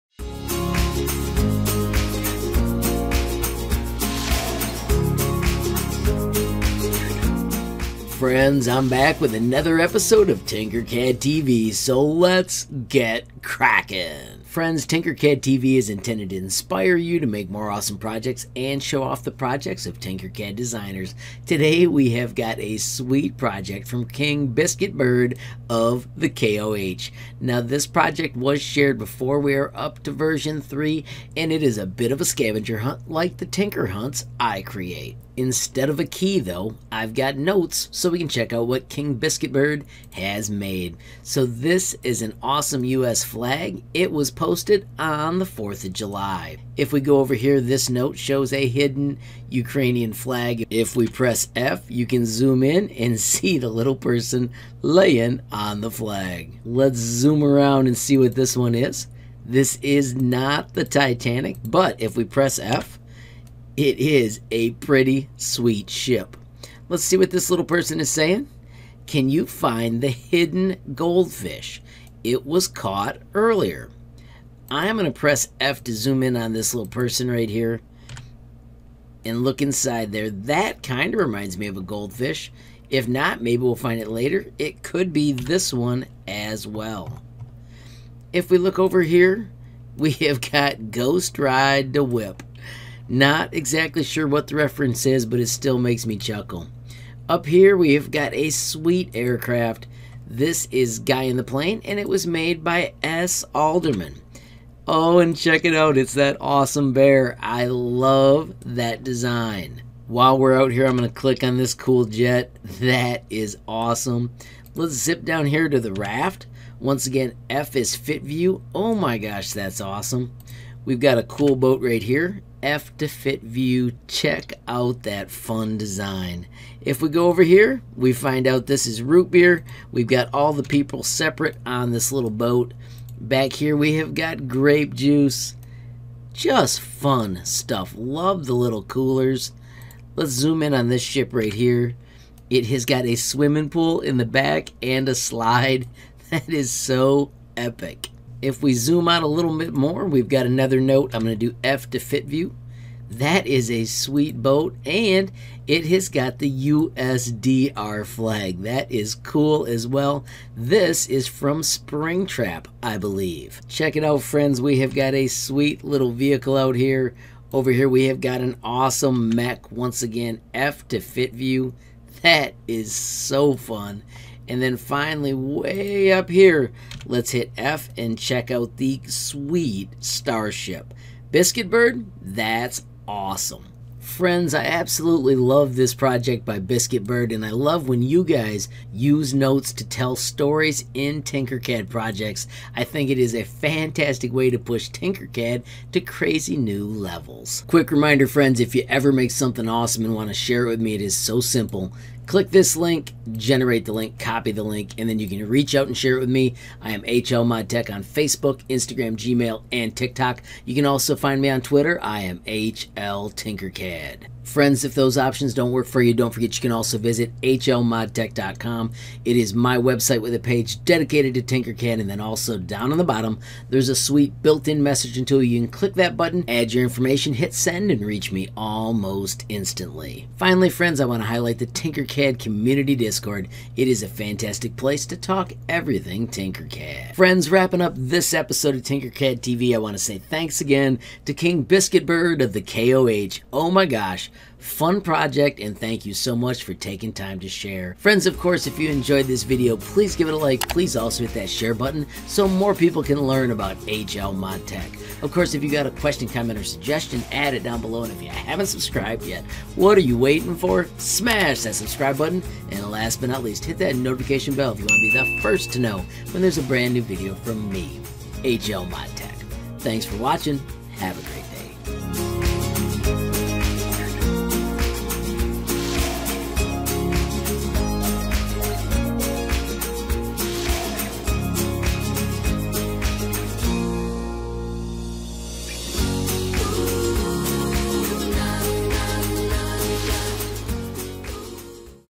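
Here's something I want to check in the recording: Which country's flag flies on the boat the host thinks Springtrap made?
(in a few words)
USSR.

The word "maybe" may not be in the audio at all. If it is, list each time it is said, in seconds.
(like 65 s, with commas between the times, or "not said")
83 s.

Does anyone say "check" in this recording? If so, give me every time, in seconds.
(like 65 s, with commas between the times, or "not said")
38 s, 105 s, 124 s, 163 s, 178 s.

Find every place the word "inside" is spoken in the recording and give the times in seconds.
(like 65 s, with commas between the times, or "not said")
79 s.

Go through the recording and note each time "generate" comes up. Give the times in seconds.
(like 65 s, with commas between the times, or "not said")
203 s.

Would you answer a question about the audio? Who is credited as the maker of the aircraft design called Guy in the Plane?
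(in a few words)
S. Alderman.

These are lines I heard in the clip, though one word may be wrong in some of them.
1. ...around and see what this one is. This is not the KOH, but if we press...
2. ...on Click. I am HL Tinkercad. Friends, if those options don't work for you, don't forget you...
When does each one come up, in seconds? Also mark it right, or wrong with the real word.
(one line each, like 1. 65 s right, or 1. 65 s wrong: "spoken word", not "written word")
1. 57 s wrong: "Titanic", not "KOH"
2. 211 s wrong: "Twitter", not "Click".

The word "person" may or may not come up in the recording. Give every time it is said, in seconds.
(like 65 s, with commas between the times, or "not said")
53 s, 67 s, 76 s.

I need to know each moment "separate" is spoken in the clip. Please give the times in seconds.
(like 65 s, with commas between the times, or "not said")
131 s.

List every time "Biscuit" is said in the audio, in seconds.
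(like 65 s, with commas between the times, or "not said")
24 s, 39 s, 181 s, 186 s, 241 s.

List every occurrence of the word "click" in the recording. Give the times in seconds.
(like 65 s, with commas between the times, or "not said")
111 s, 202 s, 225 s.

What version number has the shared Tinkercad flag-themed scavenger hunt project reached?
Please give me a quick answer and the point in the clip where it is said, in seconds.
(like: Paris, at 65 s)
3, at 30 s.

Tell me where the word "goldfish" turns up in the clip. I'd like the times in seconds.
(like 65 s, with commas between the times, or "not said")
70 s, 81 s.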